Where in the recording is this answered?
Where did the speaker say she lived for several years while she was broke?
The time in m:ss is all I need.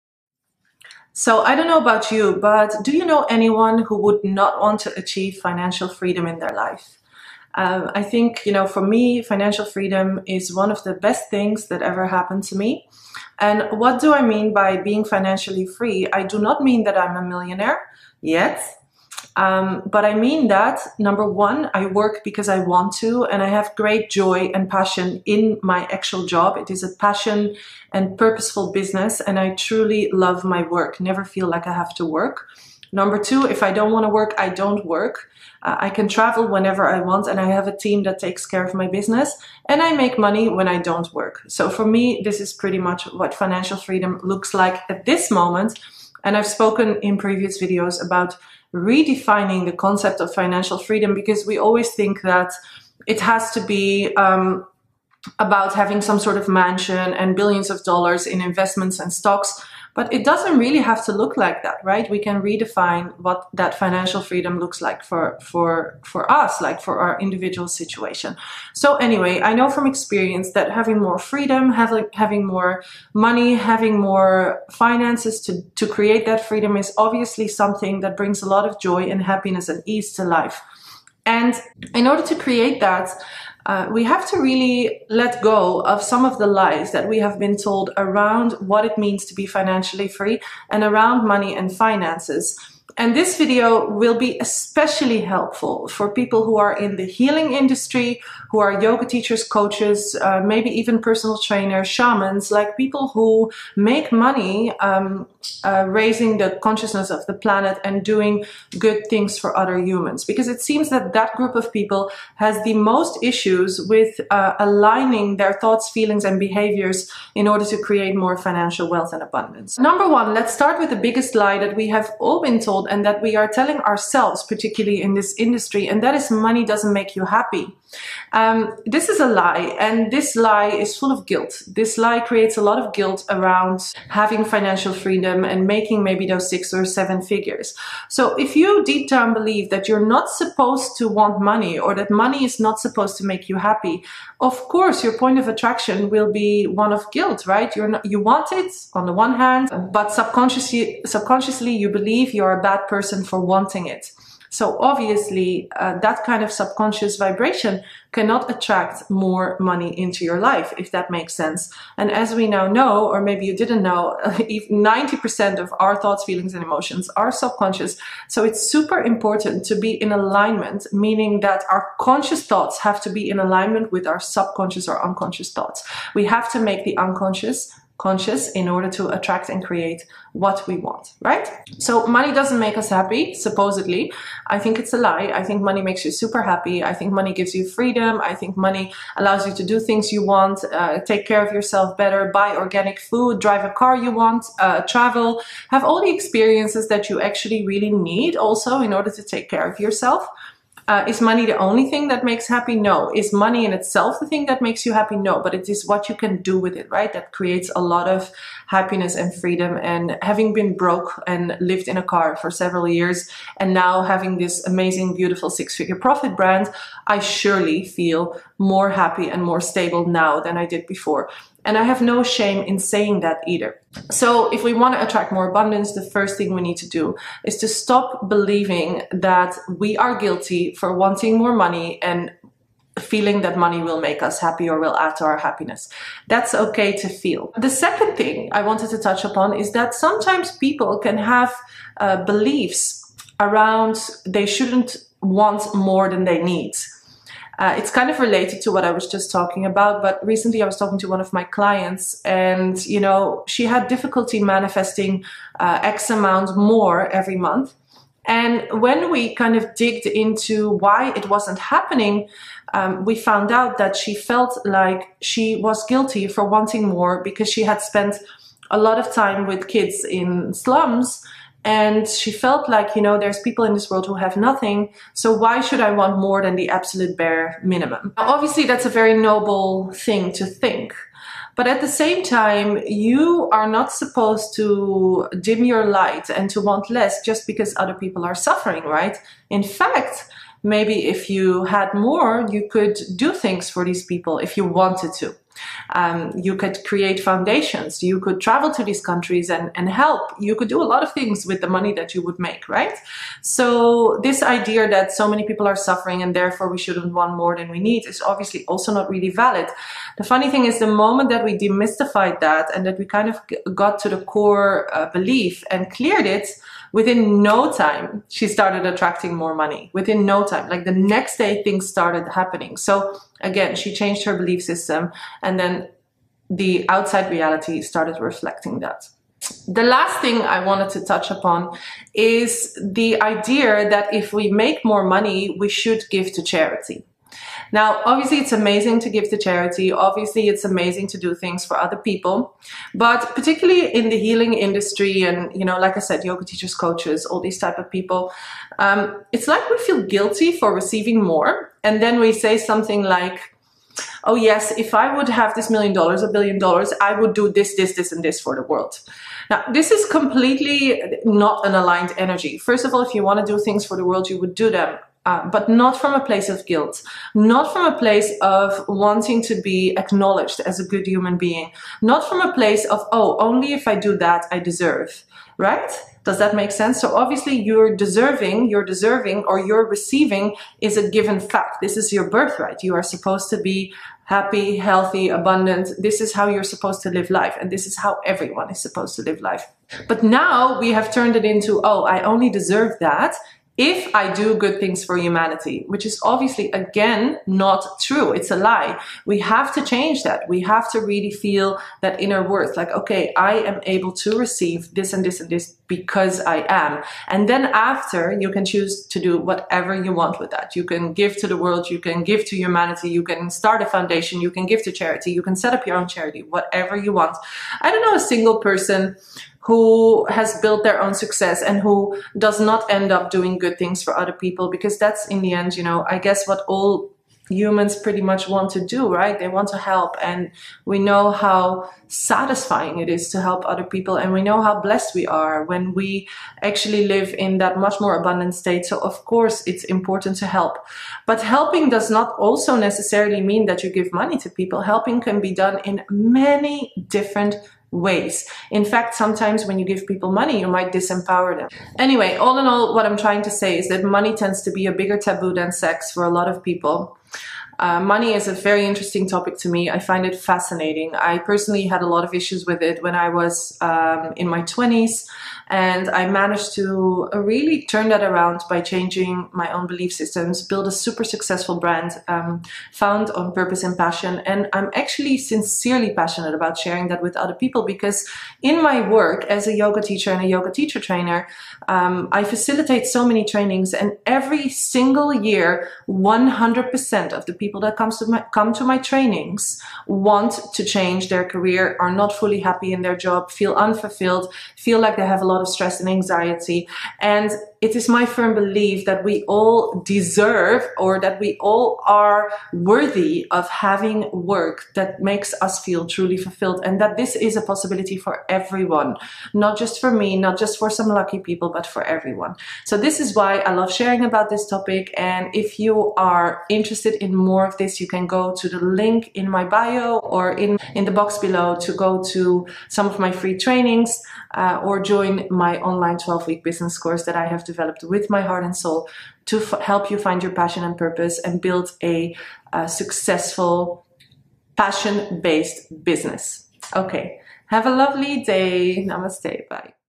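3:31.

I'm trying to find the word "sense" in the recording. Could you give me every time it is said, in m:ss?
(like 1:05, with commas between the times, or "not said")
2:41, 6:16.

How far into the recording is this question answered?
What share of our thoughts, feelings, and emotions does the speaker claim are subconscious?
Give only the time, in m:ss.
2:44.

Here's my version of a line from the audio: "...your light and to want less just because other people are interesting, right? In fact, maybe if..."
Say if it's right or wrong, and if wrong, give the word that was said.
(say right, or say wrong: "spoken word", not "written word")
wrong: "suffering", not "interesting".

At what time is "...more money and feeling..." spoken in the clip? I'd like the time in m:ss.
3:51.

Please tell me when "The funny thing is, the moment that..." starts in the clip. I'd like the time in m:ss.
5:10.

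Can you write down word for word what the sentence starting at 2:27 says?
You're not, you want it on the one hand, but subconsciously, subconsciously, you believe you're a bad person for wanting it.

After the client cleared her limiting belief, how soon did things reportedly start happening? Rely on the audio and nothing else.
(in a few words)
the next day.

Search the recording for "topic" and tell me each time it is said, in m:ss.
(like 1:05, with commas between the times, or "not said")
7:39, 8:34.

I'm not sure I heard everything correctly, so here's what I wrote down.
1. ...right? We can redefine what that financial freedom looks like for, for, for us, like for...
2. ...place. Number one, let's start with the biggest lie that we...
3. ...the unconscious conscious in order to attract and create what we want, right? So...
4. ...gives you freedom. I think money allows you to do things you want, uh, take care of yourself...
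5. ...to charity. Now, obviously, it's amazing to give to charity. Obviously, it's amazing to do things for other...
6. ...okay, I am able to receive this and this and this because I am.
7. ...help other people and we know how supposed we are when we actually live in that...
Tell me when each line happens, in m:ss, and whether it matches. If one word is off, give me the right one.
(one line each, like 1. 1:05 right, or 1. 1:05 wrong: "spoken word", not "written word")
1. 1:01 right
2. 1:59 wrong: "abundance", not "place"
3. 2:56 right
4. 3:07 right
5. 5:36 right
6. 6:42 right
7. 7:13 wrong: "blessed", not "supposed".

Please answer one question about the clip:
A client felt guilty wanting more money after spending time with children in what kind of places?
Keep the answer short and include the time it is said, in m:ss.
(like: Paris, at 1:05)
slums, at 4:30.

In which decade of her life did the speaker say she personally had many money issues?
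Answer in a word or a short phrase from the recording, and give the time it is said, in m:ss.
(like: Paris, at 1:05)
her 20s, at 7:44.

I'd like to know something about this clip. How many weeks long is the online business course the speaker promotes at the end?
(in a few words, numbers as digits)
12.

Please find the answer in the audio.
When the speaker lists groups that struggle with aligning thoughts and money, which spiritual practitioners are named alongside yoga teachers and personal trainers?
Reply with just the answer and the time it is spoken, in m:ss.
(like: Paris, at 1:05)
shamans, at 1:41.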